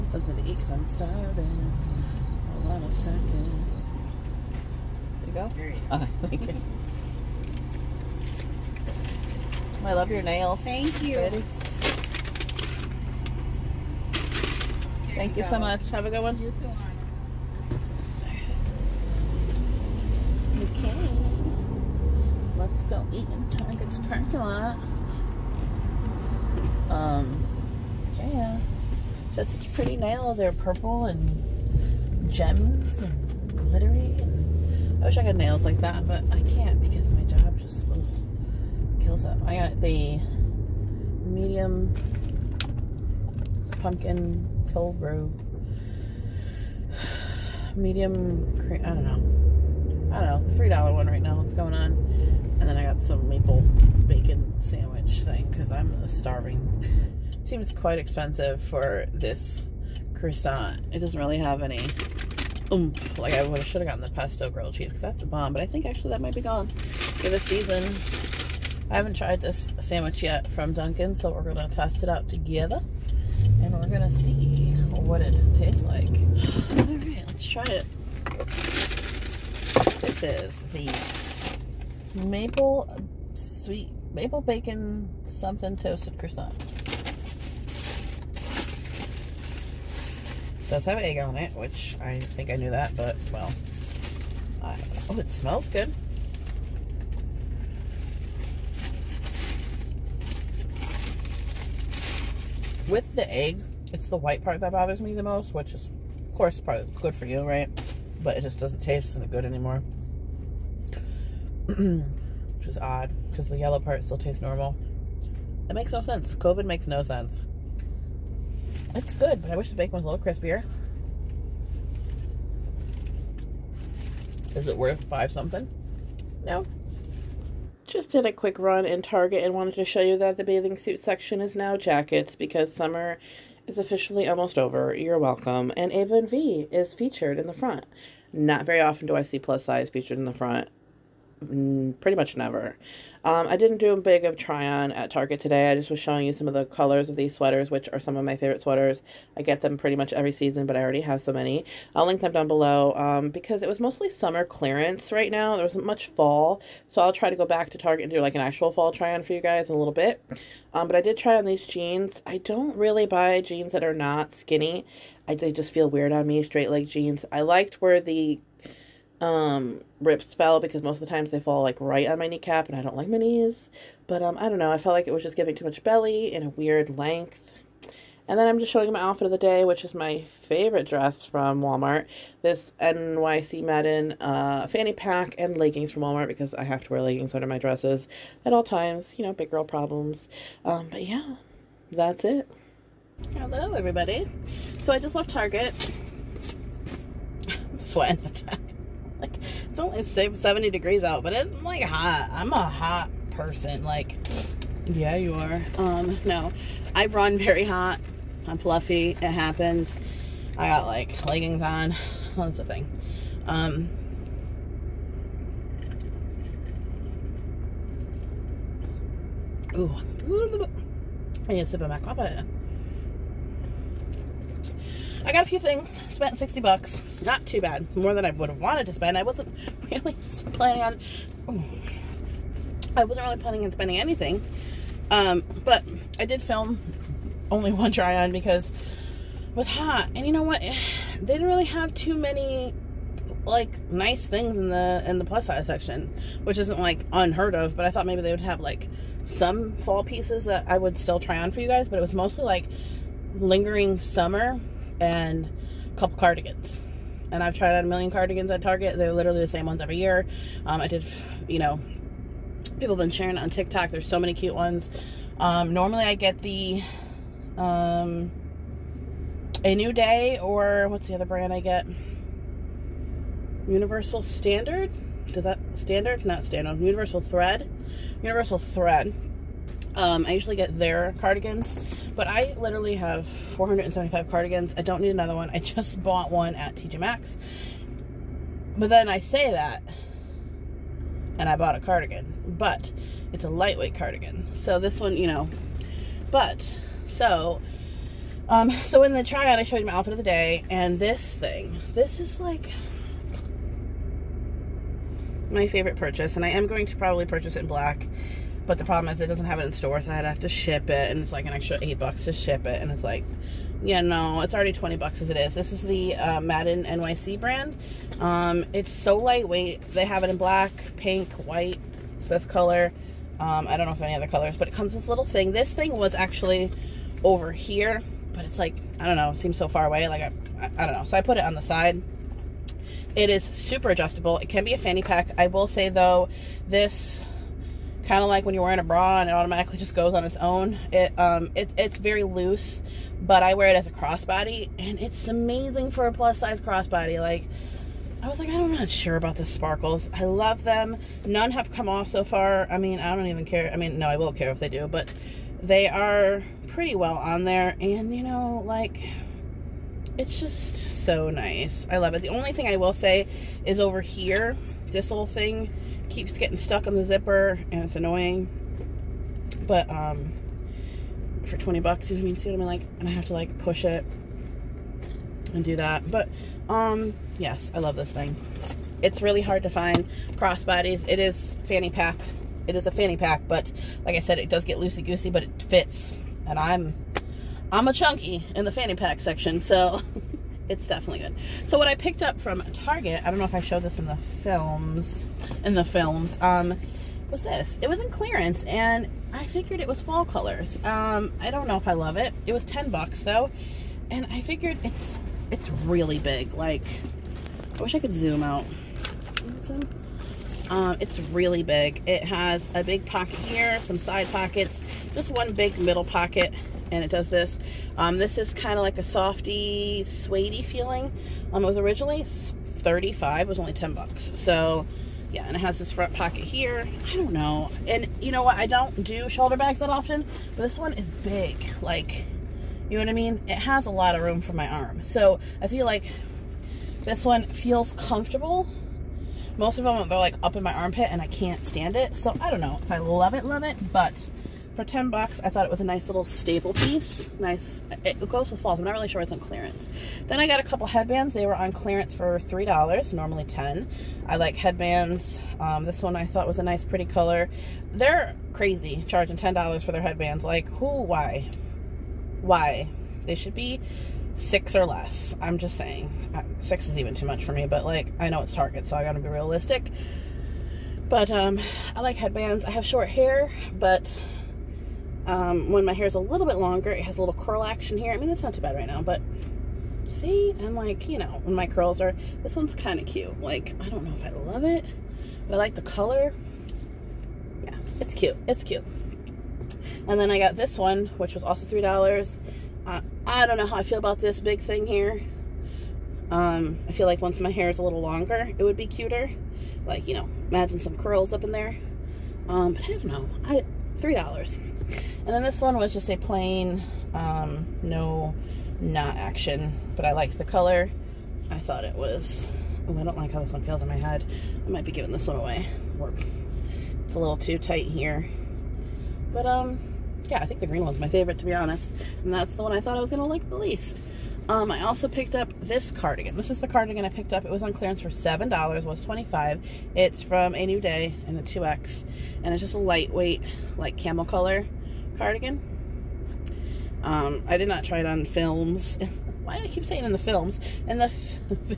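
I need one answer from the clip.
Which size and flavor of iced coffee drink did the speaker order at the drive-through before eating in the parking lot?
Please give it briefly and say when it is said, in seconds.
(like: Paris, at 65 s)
medium pumpkin cold brew, at 41 s.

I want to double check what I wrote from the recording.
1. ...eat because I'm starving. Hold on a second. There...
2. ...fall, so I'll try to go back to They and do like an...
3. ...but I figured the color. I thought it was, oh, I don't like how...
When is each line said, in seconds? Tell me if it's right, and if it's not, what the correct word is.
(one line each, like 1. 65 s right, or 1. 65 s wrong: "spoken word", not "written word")
1. 0 s right
2. 156 s wrong: "Target", not "They"
3. 509 s wrong: "liked", not "figured".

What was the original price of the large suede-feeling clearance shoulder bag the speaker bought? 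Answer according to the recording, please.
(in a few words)
$35.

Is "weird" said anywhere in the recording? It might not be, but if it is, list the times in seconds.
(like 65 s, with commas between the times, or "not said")
165 s, 176 s.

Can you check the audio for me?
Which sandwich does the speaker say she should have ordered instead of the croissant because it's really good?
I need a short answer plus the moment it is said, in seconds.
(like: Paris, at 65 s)
pesto grilled cheese, at 64 s.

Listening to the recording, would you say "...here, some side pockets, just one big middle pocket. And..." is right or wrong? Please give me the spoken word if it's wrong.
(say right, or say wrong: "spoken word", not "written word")
right.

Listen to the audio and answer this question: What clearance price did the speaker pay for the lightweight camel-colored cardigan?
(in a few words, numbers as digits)
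$7.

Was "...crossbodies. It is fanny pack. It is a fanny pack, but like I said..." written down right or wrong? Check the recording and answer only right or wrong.
right.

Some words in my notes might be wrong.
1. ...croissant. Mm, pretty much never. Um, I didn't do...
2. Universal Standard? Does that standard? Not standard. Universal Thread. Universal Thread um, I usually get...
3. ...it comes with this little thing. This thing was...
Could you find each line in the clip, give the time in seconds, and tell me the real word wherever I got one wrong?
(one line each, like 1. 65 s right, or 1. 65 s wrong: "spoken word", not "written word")
1. 140 s wrong: "front", not "croissant"
2. 273 s right
3. 324 s right.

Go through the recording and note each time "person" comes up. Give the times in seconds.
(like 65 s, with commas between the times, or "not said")
203 s.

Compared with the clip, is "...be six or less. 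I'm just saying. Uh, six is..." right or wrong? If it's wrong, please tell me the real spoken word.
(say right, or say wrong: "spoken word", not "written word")
right.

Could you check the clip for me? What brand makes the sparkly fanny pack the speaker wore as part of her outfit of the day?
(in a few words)
Madden NYC.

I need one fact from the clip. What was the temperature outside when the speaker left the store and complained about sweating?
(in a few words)
70 degrees.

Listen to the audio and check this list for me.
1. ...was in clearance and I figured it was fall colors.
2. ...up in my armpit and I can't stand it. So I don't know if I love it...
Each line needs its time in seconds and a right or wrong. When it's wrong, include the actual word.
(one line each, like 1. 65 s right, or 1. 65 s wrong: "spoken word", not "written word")
1. 397 s right
2. 440 s right.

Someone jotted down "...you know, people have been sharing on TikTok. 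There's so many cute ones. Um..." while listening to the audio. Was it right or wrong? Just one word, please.
right.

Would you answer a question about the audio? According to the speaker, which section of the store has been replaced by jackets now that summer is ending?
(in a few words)
bathing suit section.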